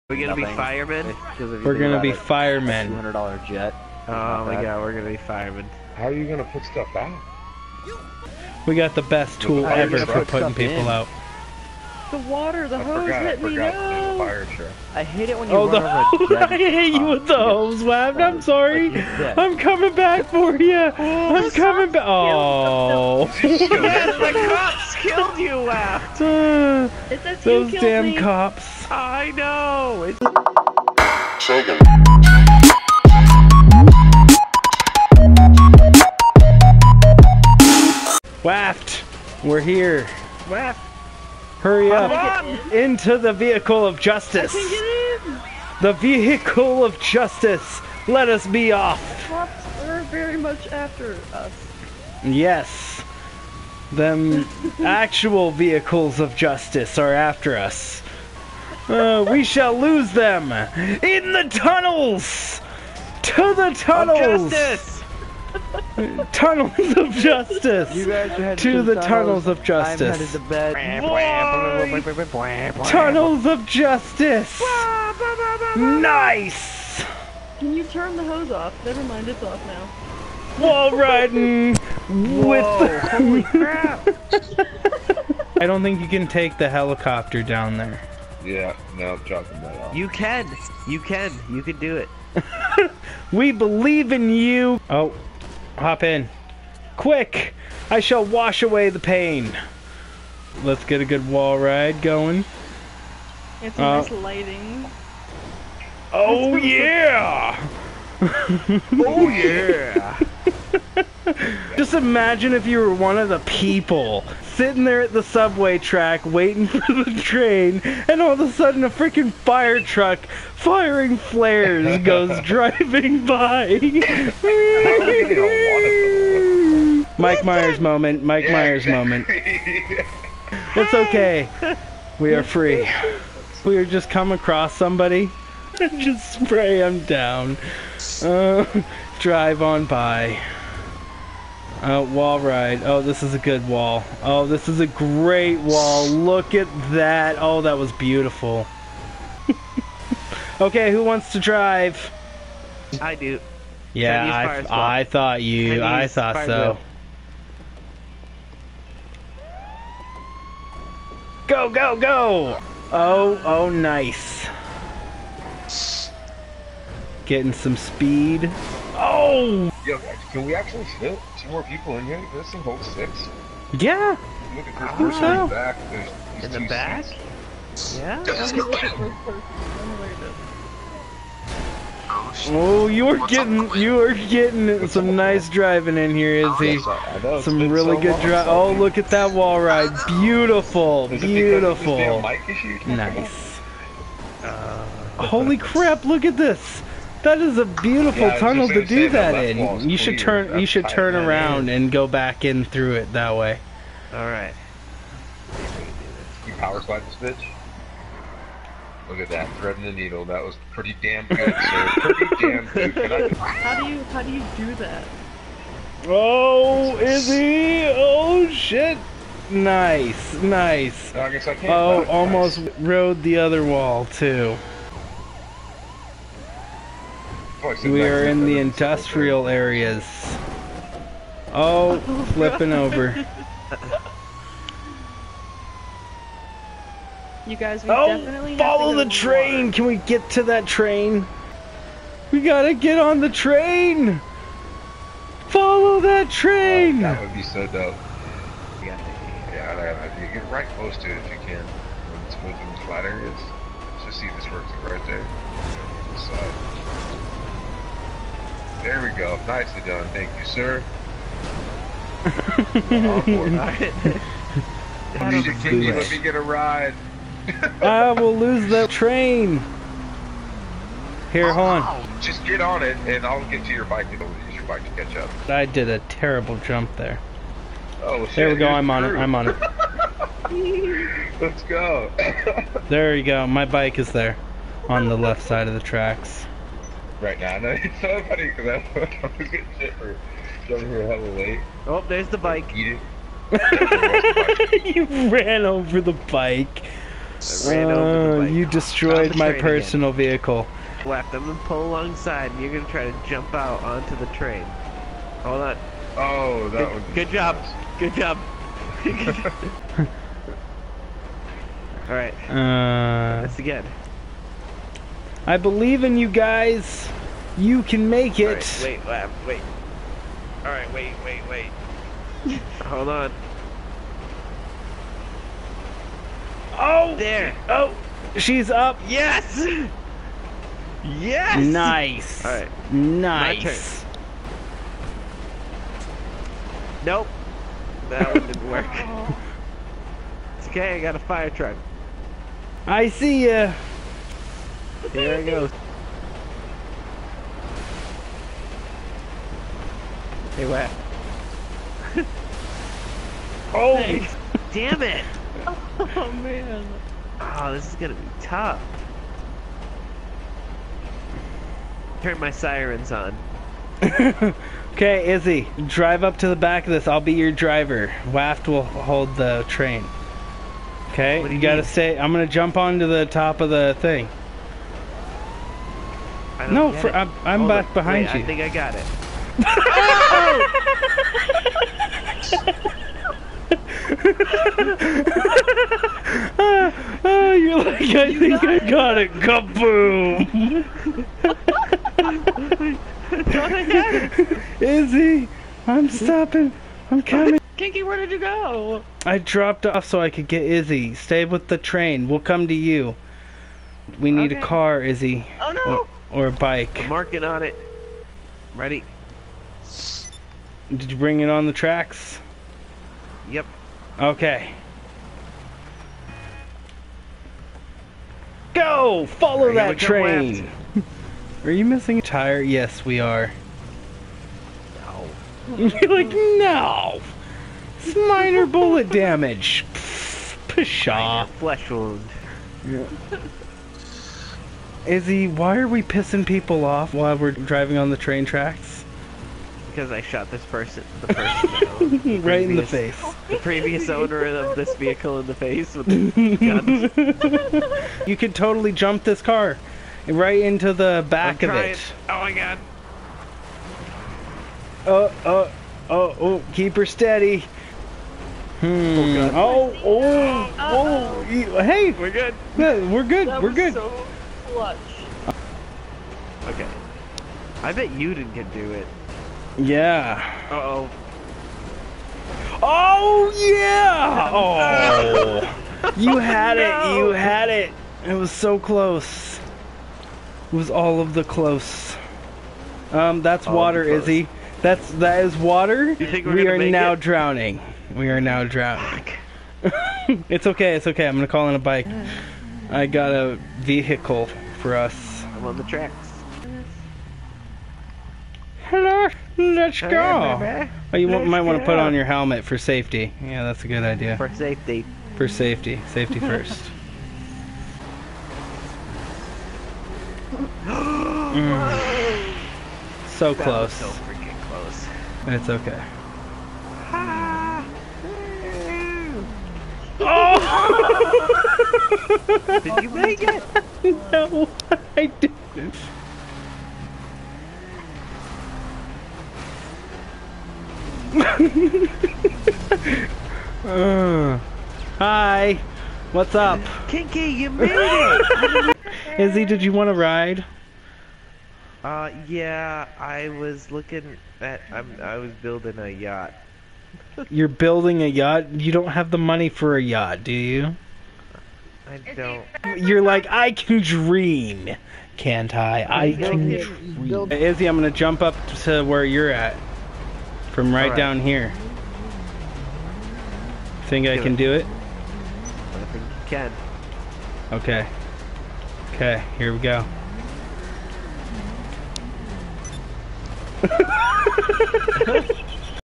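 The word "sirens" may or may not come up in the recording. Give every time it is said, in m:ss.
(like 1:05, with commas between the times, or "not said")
6:02.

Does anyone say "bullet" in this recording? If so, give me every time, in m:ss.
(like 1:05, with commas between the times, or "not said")
7:08.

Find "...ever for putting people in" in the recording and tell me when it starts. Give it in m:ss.
0:09.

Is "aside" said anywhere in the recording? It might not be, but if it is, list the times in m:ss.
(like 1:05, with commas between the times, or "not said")
not said.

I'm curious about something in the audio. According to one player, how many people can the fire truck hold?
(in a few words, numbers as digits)
Six.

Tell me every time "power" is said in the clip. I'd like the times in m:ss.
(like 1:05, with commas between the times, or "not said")
3:26.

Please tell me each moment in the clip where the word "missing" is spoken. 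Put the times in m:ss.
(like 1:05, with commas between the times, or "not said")
7:01.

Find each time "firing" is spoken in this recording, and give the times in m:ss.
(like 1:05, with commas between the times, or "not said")
2:00.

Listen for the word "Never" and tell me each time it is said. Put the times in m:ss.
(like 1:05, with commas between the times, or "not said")
1:18.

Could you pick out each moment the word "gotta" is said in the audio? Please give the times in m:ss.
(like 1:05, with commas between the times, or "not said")
4:02, 6:11.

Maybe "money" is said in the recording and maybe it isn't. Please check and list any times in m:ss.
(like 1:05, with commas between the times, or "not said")
9:09.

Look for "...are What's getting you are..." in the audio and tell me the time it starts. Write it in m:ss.
3:03.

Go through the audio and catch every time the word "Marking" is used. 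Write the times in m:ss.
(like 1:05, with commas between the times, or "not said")
6:47.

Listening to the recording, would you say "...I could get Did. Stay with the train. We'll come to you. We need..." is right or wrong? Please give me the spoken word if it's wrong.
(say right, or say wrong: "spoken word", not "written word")
wrong: "Izzi", not "Did".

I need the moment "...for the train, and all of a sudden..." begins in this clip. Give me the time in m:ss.
1:56.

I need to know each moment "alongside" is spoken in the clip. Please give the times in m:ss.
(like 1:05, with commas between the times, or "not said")
5:01.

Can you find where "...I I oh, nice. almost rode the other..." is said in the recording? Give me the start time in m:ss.
3:41.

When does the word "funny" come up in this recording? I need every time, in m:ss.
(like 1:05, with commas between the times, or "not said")
4:48.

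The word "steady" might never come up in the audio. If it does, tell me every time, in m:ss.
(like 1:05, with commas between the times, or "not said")
7:37.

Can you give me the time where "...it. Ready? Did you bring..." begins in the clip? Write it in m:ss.
6:47.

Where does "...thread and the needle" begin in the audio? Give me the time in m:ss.
3:29.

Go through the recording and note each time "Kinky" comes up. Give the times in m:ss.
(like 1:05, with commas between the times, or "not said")
6:37, 8:57.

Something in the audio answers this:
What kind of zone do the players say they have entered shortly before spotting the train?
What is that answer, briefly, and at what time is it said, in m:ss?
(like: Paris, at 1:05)
Industrial areas, at 3:48.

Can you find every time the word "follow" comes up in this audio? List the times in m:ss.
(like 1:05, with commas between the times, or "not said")
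3:58, 4:05, 6:59.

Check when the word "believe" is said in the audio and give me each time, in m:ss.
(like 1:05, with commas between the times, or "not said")
1:33, 5:15.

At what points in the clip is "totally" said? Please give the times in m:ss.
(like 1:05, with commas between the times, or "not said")
7:28.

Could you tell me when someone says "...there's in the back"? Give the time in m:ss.
2:56.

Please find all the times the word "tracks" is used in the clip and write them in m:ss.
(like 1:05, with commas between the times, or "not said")
1:55, 4:45, 6:51, 7:18, 8:15.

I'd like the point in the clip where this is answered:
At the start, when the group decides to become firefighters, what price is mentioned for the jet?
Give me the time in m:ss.
0:02.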